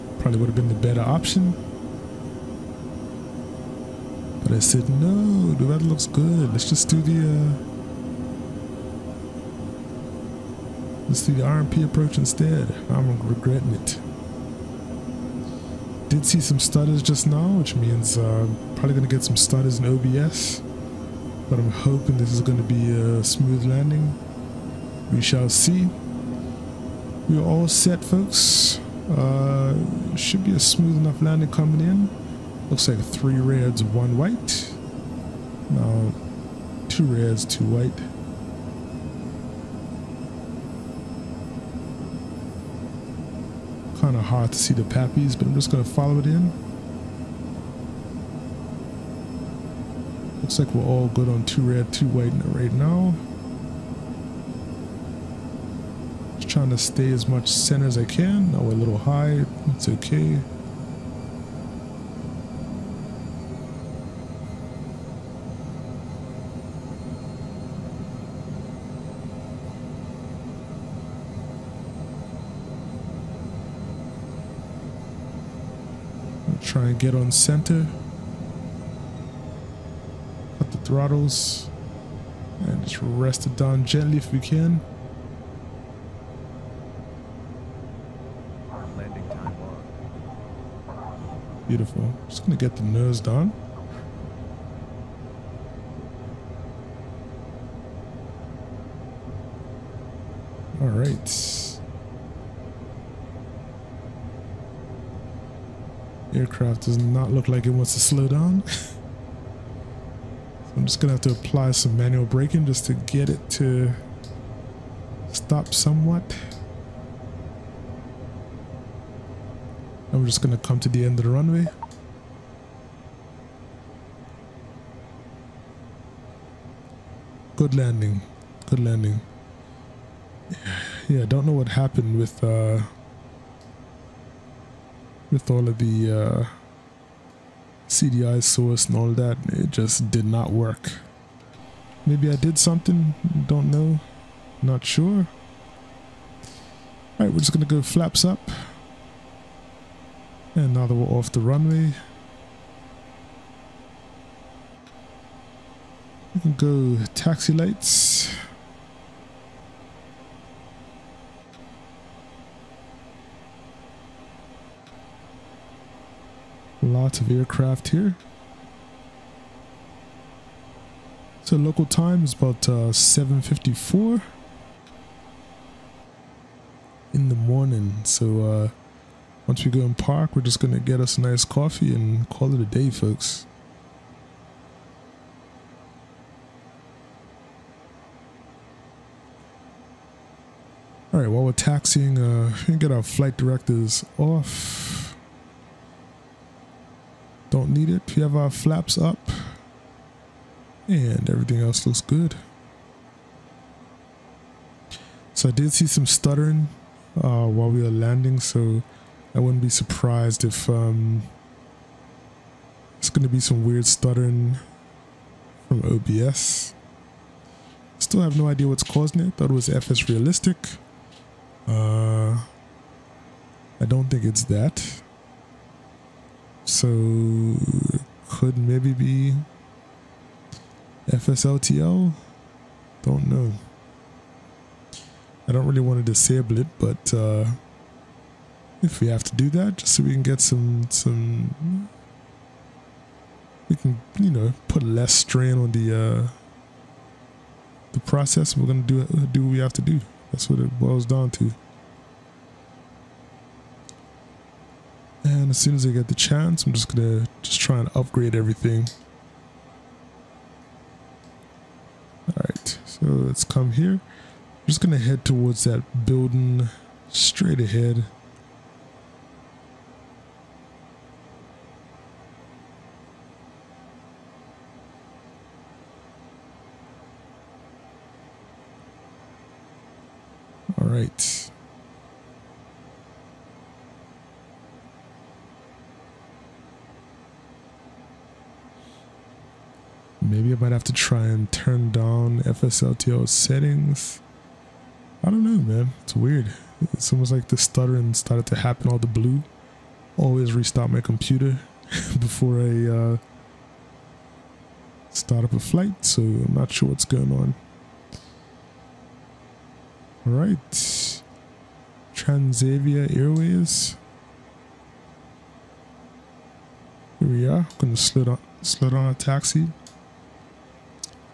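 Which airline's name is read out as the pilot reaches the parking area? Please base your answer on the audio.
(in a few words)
Transavia Airways.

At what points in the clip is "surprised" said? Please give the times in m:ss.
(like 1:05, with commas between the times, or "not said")
3:29.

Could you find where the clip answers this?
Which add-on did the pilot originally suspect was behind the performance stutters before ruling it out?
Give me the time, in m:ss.
3:39.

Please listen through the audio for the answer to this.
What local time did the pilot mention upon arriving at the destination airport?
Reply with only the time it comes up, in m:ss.
2:52.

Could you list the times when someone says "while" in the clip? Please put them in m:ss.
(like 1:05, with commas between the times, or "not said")
3:11, 3:27.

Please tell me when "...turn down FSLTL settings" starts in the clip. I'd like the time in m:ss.
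4:51.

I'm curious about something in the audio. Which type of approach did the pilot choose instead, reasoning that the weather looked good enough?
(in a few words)
RNP approach.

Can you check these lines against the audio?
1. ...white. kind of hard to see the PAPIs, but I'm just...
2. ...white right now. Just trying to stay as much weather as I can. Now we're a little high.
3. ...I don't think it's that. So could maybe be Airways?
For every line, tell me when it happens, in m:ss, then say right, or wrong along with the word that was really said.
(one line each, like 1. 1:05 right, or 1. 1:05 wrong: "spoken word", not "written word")
1. 0:37 right
2. 0:52 wrong: "center", not "weather"
3. 3:43 wrong: "FSLTL", not "Airways".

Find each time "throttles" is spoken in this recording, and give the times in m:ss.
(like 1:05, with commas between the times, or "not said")
1:20.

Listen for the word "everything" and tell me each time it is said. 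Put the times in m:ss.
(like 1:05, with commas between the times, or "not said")
3:21, 4:18.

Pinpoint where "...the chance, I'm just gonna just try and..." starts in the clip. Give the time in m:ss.
4:16.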